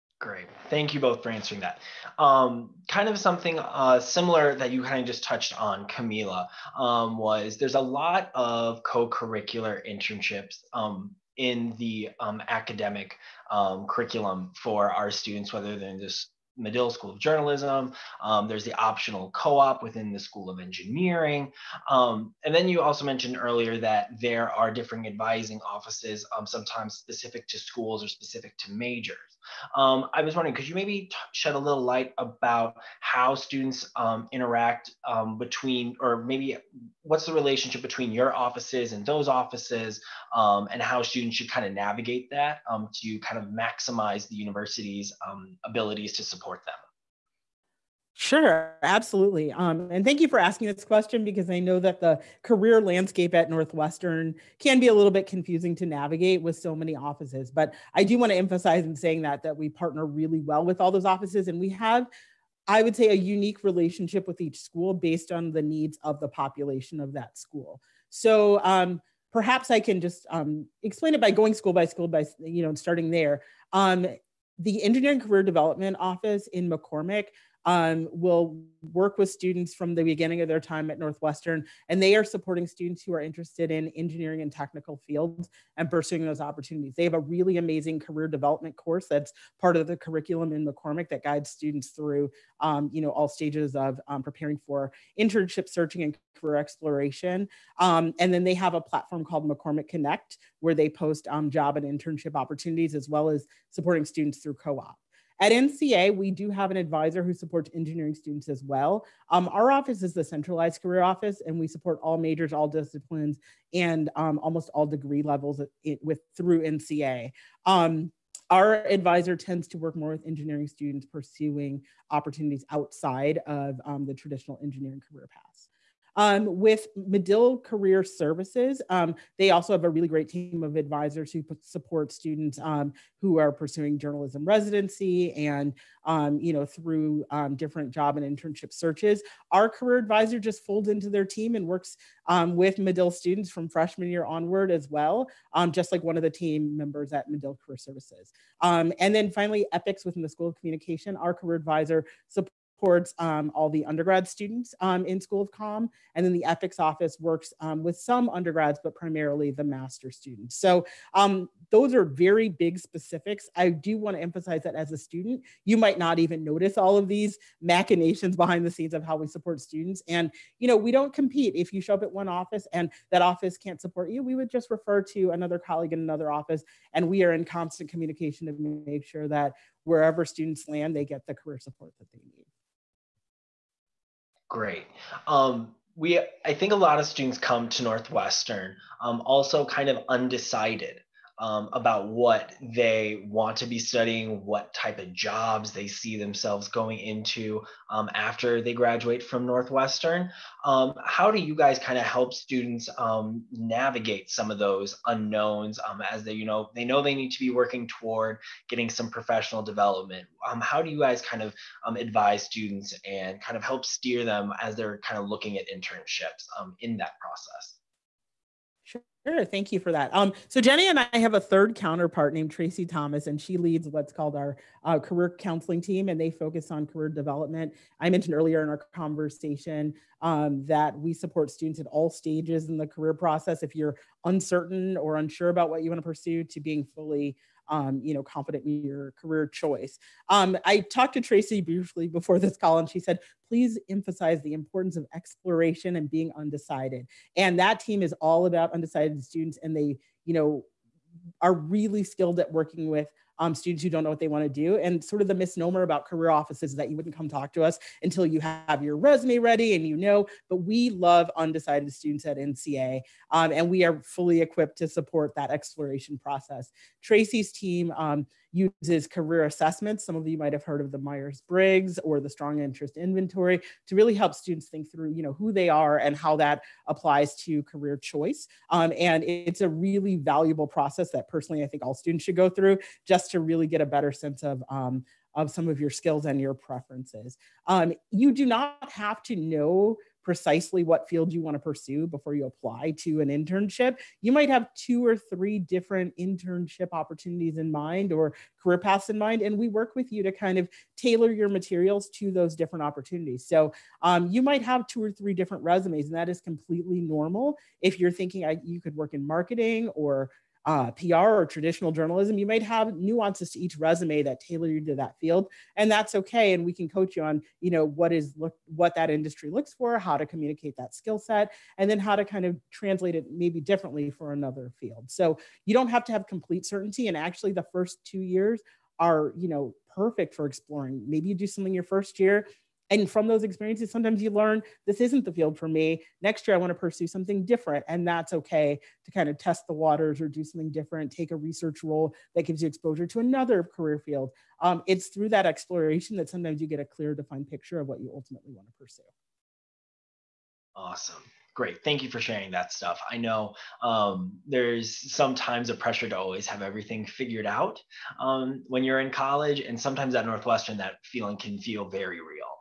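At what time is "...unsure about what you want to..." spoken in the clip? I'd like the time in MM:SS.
03:55.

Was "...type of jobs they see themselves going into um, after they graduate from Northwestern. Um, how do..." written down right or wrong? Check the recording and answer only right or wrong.
right.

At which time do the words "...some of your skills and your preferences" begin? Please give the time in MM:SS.
04:45.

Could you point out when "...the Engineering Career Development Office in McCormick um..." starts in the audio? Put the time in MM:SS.
01:14.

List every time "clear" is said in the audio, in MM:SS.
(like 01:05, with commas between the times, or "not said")
05:46.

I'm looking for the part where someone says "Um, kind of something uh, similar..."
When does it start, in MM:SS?
00:02.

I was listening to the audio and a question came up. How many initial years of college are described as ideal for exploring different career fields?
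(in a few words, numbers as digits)
2.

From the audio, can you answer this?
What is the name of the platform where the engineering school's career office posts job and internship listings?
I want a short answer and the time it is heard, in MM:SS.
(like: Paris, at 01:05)
McCormick Connect, at 01:39.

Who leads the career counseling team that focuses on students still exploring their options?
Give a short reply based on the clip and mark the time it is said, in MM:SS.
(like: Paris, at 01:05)
Tracy Thomas, at 03:42.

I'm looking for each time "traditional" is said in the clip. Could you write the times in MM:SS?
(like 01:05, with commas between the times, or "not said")
02:04, 05:11.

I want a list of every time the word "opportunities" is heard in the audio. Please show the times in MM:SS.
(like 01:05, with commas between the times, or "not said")
01:26, 01:42, 02:02, 04:56, 05:02.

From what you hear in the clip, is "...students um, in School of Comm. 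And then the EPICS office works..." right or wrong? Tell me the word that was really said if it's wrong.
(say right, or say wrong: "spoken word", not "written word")
right.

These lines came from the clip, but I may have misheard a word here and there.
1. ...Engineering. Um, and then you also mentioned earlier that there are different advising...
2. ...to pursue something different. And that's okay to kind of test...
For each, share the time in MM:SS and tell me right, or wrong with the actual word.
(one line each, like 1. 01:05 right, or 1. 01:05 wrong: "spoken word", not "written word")
1. 00:20 right
2. 05:36 right.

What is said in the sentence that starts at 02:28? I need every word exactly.
and then finally, EPICS within the School of Communication.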